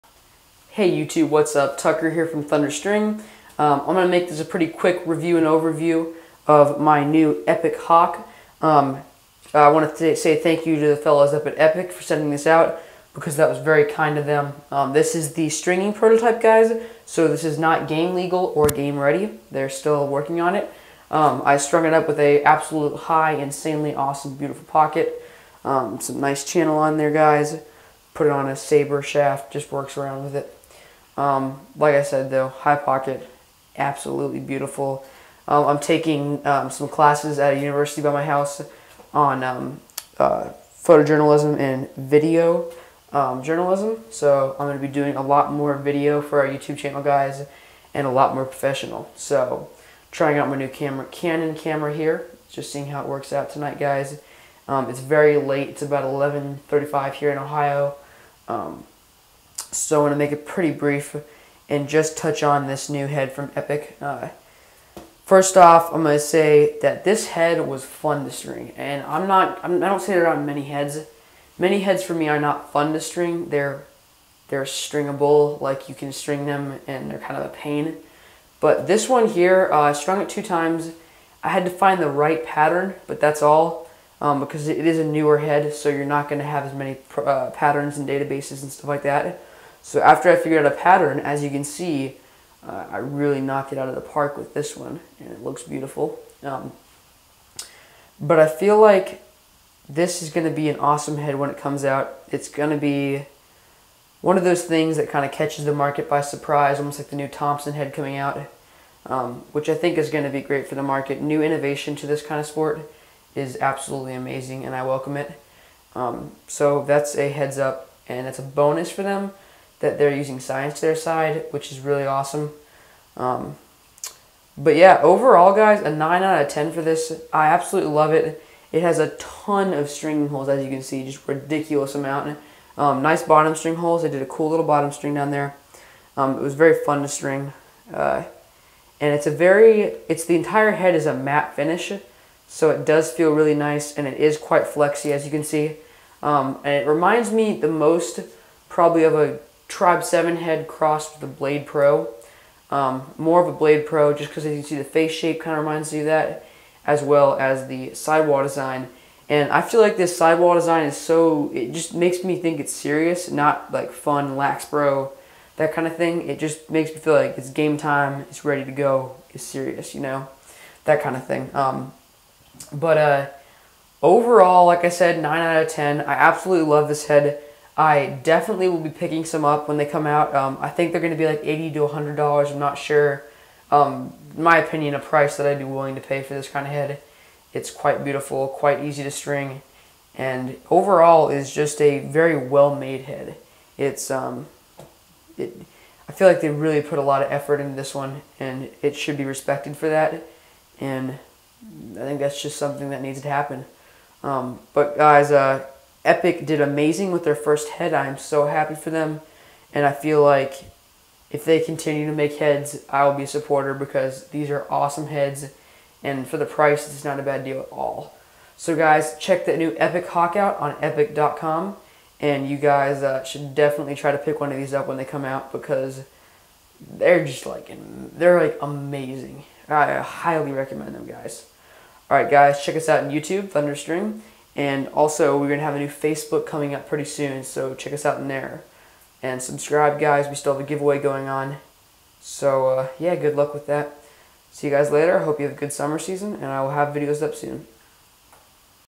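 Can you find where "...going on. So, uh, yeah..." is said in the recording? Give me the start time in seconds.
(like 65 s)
240 s.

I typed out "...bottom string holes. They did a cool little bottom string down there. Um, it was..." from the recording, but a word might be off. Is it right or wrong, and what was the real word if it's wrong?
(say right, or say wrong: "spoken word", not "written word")
right.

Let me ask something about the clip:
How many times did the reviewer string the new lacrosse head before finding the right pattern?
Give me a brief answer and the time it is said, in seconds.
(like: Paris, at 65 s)
2, at 80 s.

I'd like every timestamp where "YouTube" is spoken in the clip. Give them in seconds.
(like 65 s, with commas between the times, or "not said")
0 s, 46 s, 233 s.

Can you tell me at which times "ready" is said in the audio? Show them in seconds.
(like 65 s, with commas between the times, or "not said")
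18 s, 168 s.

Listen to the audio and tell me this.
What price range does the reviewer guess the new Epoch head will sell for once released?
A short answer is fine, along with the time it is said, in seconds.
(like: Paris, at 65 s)
$80 to $100, at 181 s.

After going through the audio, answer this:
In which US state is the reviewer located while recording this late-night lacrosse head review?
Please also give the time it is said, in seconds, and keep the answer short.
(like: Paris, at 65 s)
Ohio, at 57 s.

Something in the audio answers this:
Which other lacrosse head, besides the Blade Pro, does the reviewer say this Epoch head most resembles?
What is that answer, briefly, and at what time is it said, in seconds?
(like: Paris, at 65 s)
Tribe 7, at 149 s.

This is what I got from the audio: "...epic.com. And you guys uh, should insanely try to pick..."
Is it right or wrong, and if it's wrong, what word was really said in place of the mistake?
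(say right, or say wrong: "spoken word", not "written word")
wrong: "definitely", not "insanely".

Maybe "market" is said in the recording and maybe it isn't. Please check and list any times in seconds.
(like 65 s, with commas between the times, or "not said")
105 s, 110 s.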